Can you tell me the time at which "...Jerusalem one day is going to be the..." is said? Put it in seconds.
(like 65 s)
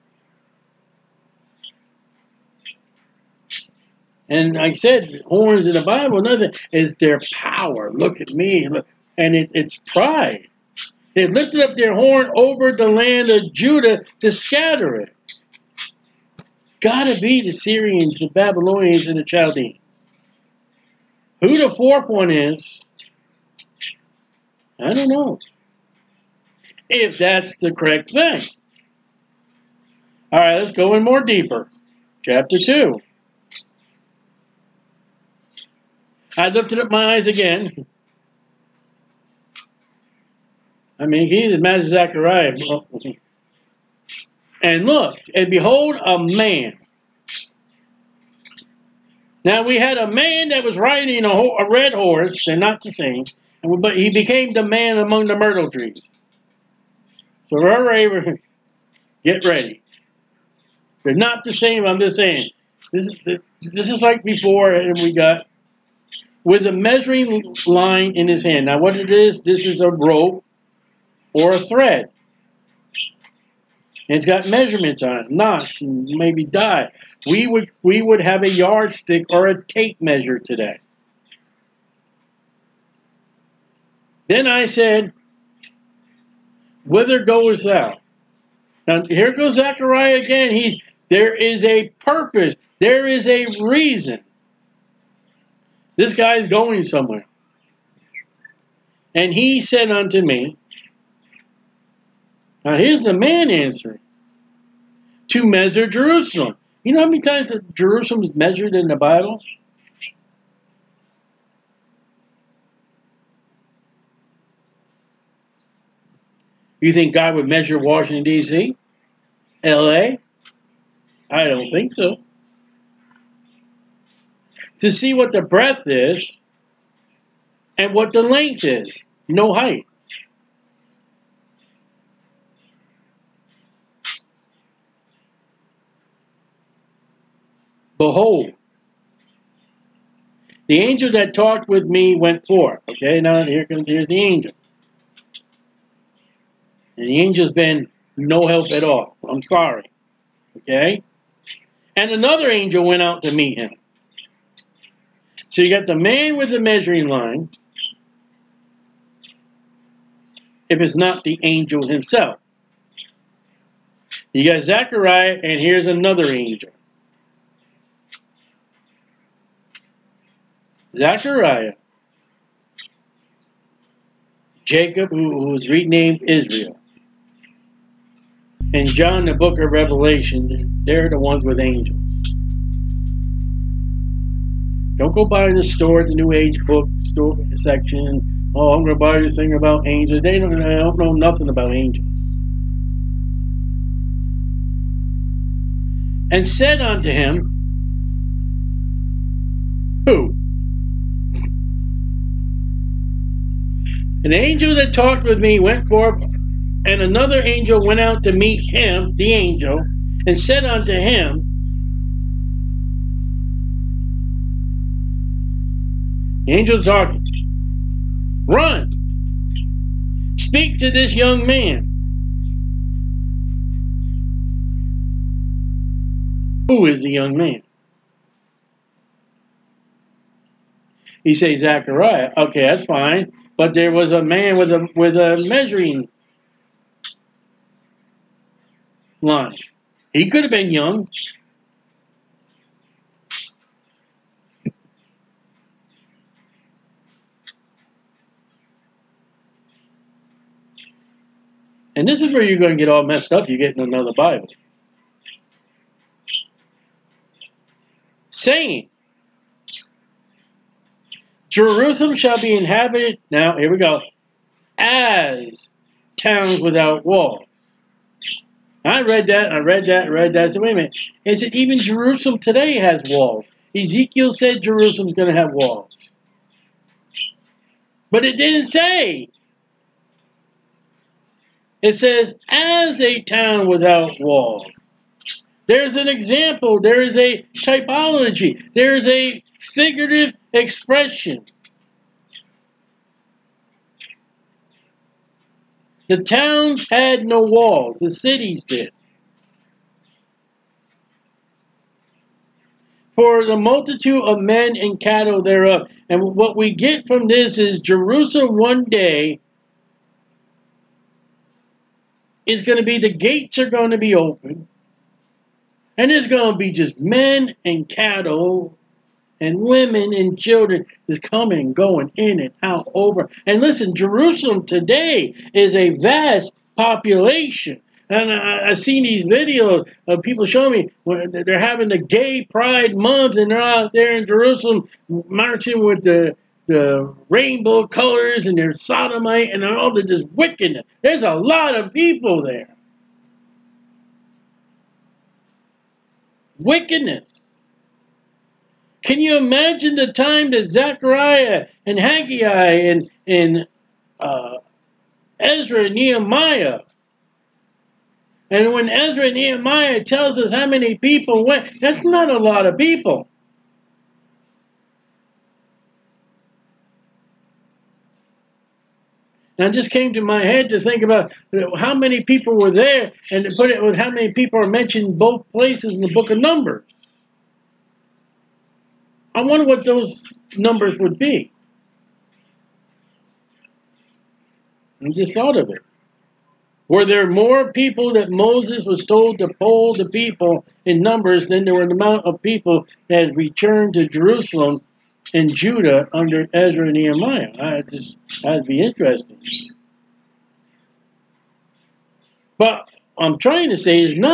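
307 s.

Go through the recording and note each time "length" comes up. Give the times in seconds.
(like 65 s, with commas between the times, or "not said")
128 s.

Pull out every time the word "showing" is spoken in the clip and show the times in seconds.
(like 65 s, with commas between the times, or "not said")
330 s.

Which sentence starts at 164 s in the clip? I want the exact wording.
You got Zechariah, and here's another angel.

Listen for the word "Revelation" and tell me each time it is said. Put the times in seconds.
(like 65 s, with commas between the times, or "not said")
179 s.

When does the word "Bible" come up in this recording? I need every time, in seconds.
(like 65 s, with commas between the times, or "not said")
5 s, 108 s, 254 s.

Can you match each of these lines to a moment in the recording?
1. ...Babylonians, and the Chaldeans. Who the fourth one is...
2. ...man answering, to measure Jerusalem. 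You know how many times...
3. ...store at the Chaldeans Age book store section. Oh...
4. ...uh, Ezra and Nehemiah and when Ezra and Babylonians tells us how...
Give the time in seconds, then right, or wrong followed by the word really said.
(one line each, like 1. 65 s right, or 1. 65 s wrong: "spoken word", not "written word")
1. 18 s right
2. 103 s right
3. 185 s wrong: "New", not "Chaldeans"
4. 354 s wrong: "Nehemiah", not "Babylonians".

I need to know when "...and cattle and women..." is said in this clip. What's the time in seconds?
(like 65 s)
317 s.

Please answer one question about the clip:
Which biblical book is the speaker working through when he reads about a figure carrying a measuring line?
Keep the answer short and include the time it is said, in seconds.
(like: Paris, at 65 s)
Chapter 2, at 32 s.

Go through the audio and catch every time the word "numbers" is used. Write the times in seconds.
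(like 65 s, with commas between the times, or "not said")
376 s, 380 s, 391 s.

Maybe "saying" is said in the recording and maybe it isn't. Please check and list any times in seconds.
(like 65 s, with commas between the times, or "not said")
62 s, 258 s.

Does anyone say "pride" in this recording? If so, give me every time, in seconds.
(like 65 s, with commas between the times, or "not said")
9 s, 332 s.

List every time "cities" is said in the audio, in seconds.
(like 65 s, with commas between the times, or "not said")
298 s.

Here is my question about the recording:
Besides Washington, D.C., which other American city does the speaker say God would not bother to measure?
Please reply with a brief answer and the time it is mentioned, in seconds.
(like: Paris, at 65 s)
L.A., at 119 s.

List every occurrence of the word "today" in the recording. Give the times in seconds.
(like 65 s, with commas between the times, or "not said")
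80 s, 272 s, 324 s.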